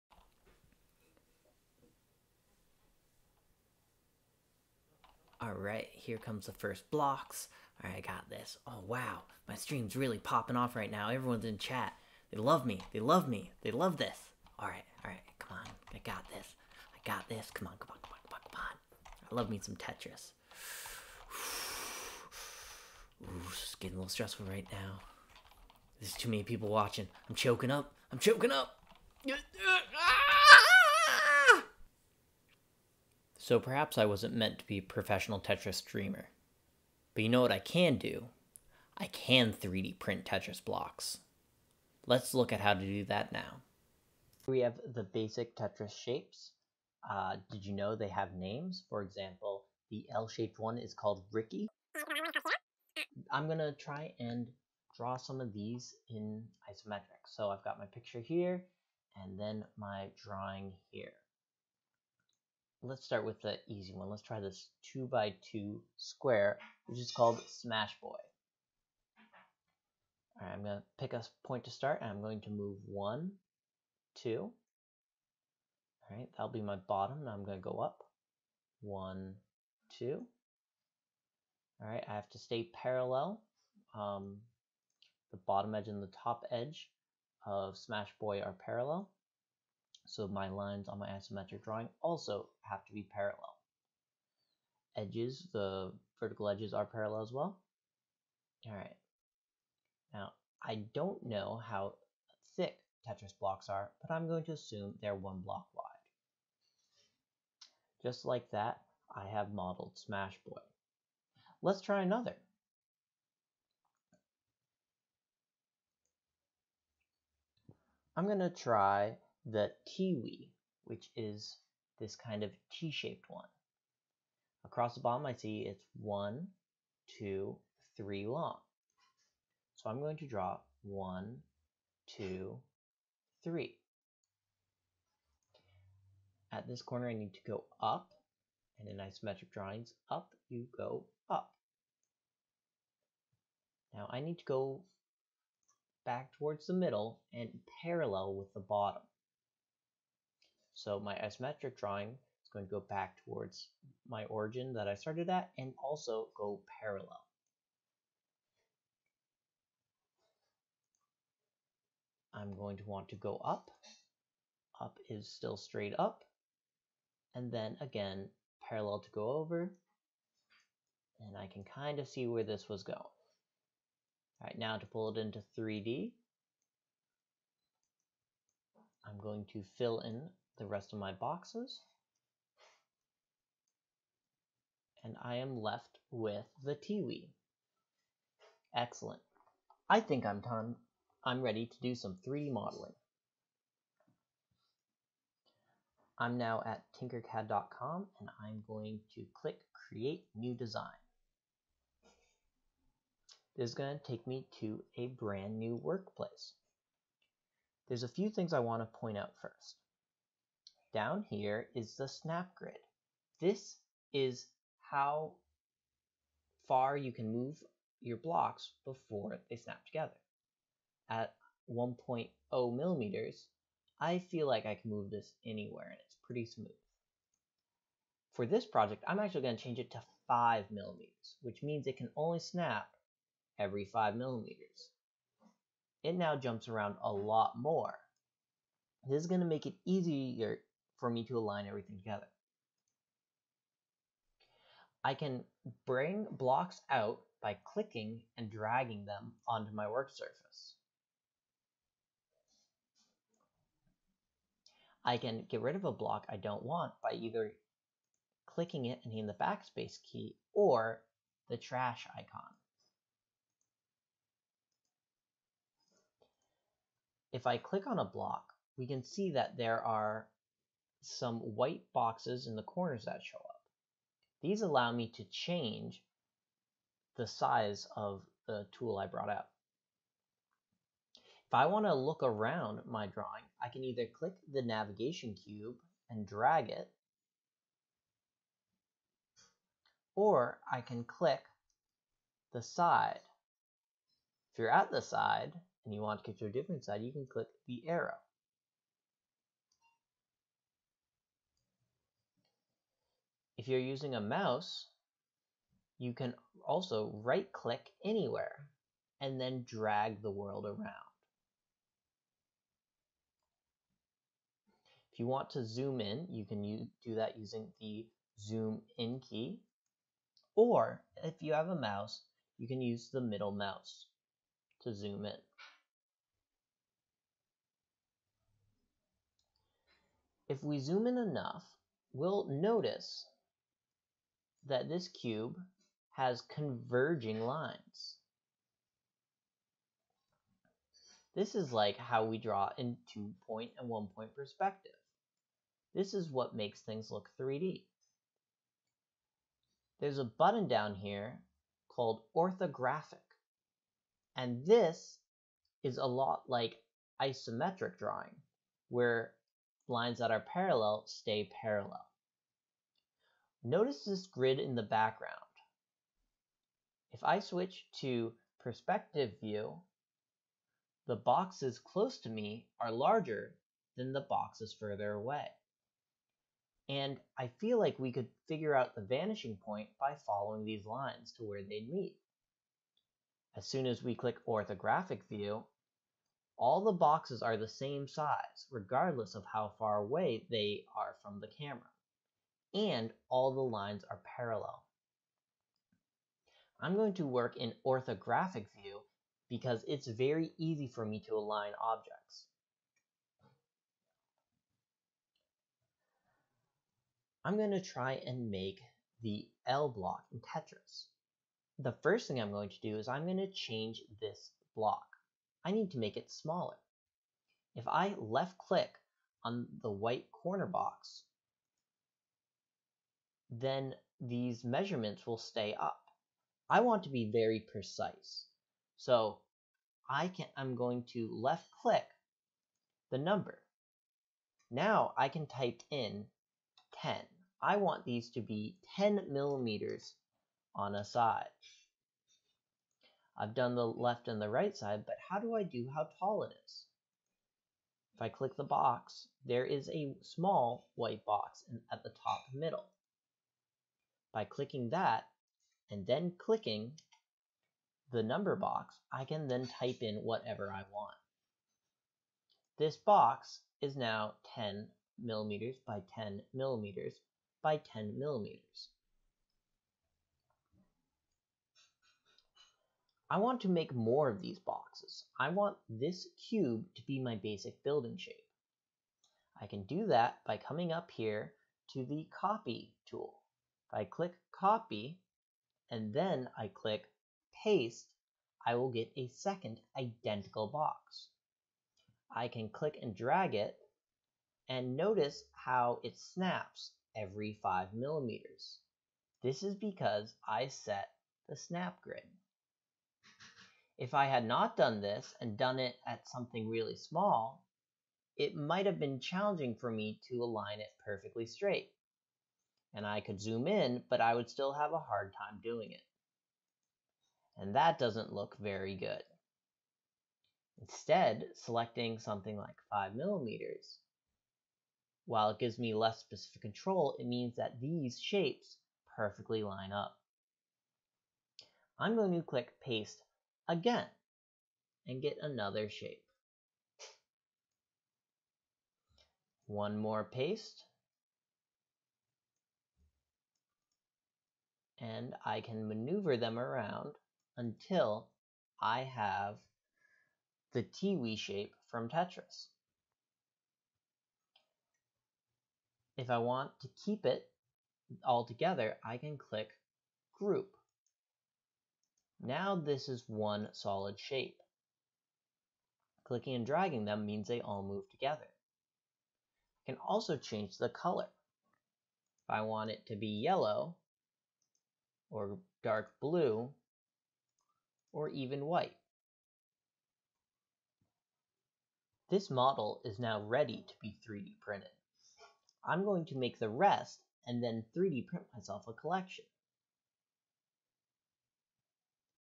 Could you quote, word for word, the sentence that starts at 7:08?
So I can, I'm going to left click the number.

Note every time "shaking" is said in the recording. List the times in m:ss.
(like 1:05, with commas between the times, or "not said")
not said.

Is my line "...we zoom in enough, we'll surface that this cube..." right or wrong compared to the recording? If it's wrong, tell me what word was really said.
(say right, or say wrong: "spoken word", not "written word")
wrong: "notice", not "surface".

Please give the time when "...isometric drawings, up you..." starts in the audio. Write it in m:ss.
2:18.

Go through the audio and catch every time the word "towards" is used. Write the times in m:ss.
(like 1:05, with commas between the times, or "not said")
2:26, 2:33.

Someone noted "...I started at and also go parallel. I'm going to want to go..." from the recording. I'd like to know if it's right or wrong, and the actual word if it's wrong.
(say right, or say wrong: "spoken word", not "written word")
right.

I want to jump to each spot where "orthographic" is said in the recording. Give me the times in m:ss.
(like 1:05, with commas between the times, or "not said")
5:52, 6:24, 6:37.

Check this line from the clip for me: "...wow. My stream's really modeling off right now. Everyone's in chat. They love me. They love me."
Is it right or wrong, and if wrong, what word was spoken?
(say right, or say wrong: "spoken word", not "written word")
wrong: "popping", not "modeling".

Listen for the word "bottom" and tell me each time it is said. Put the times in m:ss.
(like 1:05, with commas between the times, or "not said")
1:16, 1:25, 2:05, 2:28.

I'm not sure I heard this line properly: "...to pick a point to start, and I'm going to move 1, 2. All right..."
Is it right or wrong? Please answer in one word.
right.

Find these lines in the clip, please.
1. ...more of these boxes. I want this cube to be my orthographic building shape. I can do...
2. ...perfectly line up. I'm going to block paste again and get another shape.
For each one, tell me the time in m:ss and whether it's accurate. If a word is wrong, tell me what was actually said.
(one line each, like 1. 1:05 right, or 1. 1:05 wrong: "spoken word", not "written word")
1. 7:53 wrong: "basic", not "orthographic"
2. 8:49 wrong: "click", not "block".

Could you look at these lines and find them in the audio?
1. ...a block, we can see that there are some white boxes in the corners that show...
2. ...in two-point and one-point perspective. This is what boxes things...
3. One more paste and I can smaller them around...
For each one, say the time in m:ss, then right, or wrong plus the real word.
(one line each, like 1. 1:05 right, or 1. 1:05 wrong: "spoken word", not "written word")
1. 4:27 right
2. 5:42 wrong: "makes", not "boxes"
3. 8:59 wrong: "maneuver", not "smaller".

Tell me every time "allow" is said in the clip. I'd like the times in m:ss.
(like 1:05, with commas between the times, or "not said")
4:34.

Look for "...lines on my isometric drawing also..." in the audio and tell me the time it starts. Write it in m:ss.
1:30.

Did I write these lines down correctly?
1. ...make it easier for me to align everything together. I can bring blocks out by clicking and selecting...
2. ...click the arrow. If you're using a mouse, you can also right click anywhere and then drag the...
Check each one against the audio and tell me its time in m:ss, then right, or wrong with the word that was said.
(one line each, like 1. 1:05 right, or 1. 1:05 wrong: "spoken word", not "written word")
1. 3:59 wrong: "dragging", not "selecting"
2. 4:57 right.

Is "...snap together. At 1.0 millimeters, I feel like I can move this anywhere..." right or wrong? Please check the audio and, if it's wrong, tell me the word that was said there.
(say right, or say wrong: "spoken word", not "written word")
right.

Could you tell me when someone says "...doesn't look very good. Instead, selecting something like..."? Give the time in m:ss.
8:37.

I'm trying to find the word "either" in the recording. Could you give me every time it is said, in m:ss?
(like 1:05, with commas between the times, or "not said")
4:17, 4:43.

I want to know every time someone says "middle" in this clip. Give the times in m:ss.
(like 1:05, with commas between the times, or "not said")
2:26, 5:23, 7:32.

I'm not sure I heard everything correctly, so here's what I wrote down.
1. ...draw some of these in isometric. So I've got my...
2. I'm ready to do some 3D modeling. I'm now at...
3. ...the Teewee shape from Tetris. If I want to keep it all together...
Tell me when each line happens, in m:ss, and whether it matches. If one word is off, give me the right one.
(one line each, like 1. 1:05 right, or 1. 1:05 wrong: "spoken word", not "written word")
1. 0:54 right
2. 3:11 right
3. 9:10 right.